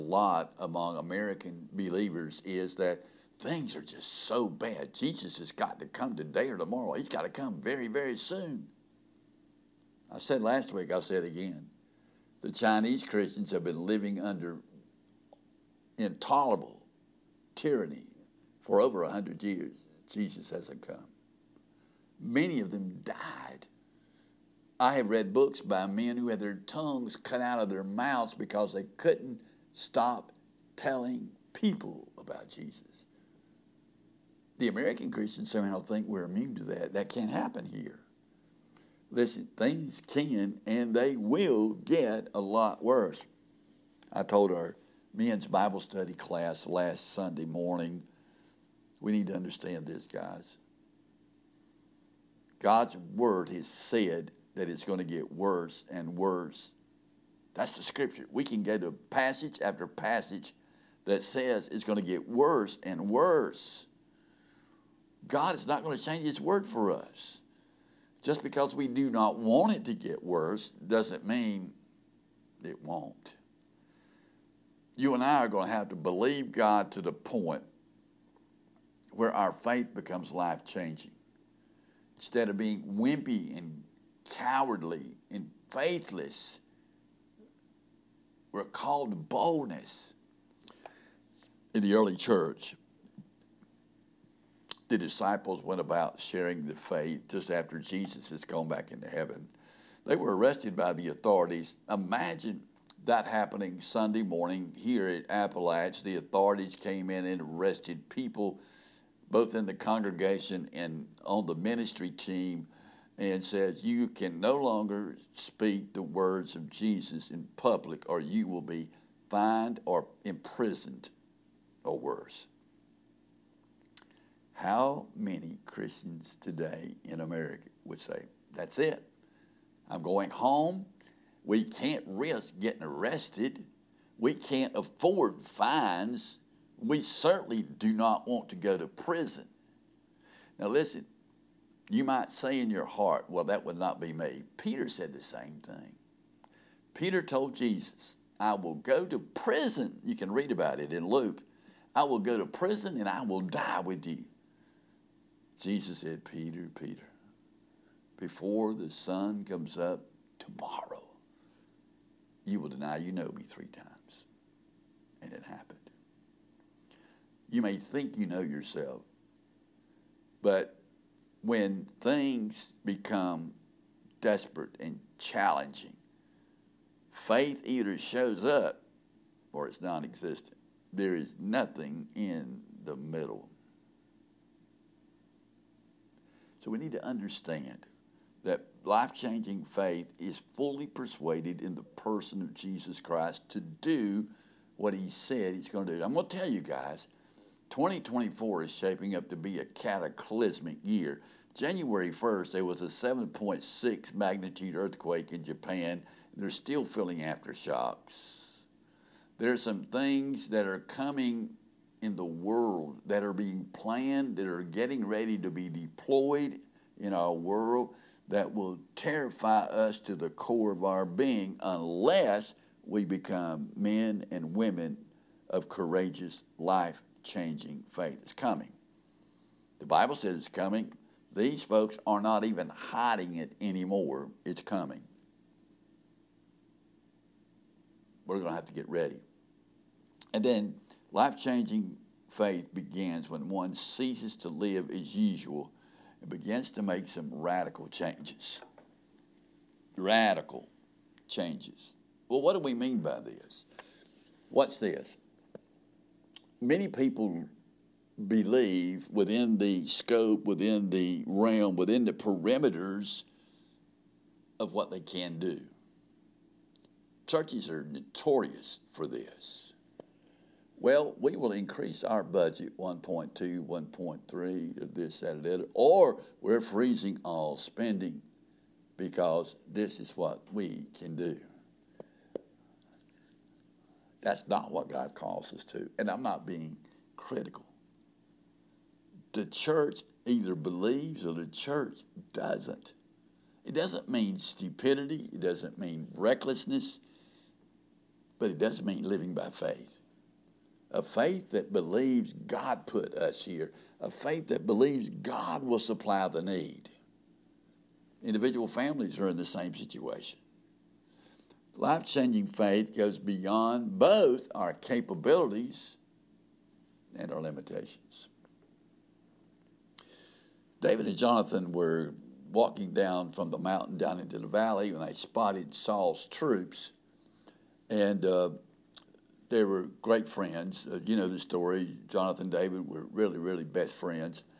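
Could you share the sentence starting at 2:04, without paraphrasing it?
How many Christians today in America would say, That's it?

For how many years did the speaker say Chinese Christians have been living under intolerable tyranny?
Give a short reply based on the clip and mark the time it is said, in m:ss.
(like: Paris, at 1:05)
100, at 0:19.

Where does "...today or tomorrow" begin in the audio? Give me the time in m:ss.
0:06.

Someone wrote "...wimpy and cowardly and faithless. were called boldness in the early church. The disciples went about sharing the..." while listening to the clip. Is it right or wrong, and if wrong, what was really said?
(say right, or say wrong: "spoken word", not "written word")
right.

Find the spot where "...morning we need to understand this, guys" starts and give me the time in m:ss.
0:47.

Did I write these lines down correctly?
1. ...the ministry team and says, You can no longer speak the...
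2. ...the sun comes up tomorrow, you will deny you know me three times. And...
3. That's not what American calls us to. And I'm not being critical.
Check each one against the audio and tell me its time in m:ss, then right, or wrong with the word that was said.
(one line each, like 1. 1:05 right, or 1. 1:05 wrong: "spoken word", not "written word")
1. 1:51 right
2. 2:38 right
3. 4:44 wrong: "God", not "American".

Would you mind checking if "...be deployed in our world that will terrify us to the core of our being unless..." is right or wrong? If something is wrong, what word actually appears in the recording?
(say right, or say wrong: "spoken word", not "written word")
right.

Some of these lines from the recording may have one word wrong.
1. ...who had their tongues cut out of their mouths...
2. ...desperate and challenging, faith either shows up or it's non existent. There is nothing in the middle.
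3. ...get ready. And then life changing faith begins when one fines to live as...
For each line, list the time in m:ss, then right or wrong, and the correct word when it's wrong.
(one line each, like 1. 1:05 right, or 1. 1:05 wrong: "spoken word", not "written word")
1. 0:26 right
2. 2:54 right
3. 3:58 wrong: "ceases", not "fines".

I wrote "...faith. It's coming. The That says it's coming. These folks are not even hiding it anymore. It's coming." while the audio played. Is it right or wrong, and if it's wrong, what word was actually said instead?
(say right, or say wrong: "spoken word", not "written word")
wrong: "Bible", not "That".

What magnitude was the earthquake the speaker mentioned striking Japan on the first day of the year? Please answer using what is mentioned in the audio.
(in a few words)
7.6.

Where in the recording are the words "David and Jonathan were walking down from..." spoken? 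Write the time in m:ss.
5:20.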